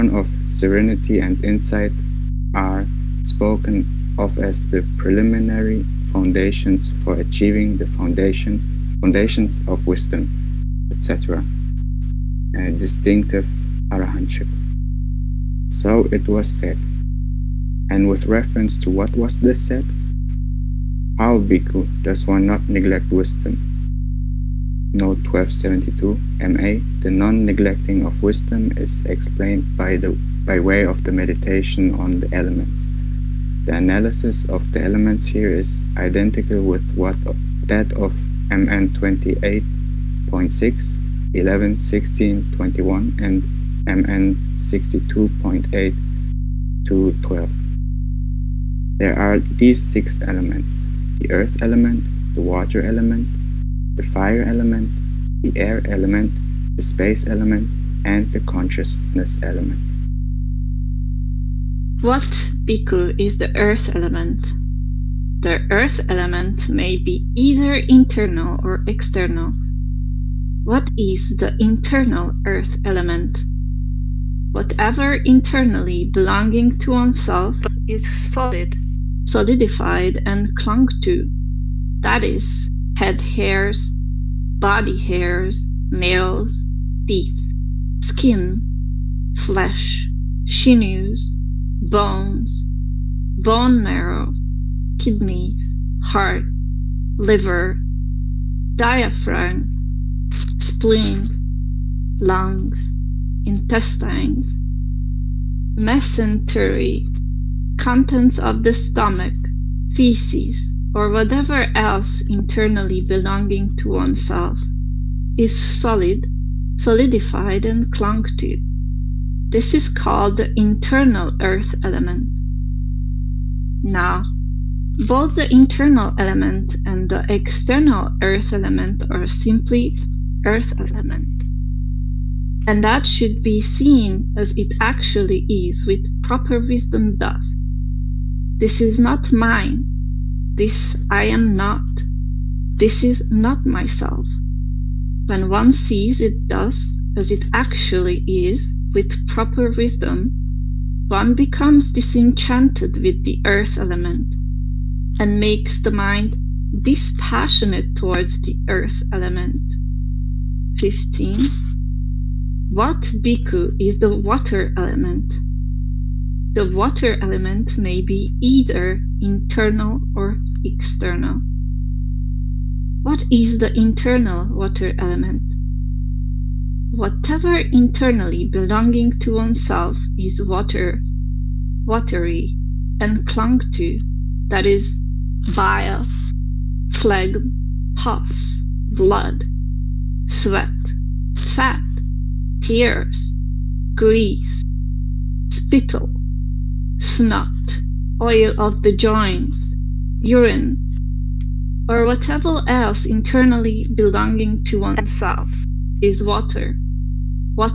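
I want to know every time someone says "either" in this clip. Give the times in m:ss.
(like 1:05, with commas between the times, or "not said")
1:07, 2:48.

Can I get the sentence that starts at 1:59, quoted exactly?
This is called the internal earth element.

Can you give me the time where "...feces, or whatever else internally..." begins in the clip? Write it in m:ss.
1:49.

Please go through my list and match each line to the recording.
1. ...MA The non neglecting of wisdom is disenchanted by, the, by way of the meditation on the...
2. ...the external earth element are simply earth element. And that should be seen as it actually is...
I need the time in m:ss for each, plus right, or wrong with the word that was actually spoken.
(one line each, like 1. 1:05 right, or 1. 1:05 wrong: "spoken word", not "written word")
1. 0:26 wrong: "explained", not "disenchanted"
2. 2:07 right.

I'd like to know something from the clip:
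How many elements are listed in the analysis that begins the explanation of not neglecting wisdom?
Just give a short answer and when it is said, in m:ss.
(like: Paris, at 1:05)
6, at 0:49.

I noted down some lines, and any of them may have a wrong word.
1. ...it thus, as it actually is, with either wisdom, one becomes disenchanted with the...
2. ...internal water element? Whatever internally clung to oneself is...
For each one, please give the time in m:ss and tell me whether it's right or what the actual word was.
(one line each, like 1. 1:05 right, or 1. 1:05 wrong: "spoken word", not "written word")
1. 2:26 wrong: "proper", not "either"
2. 2:53 wrong: "belonging", not "clung".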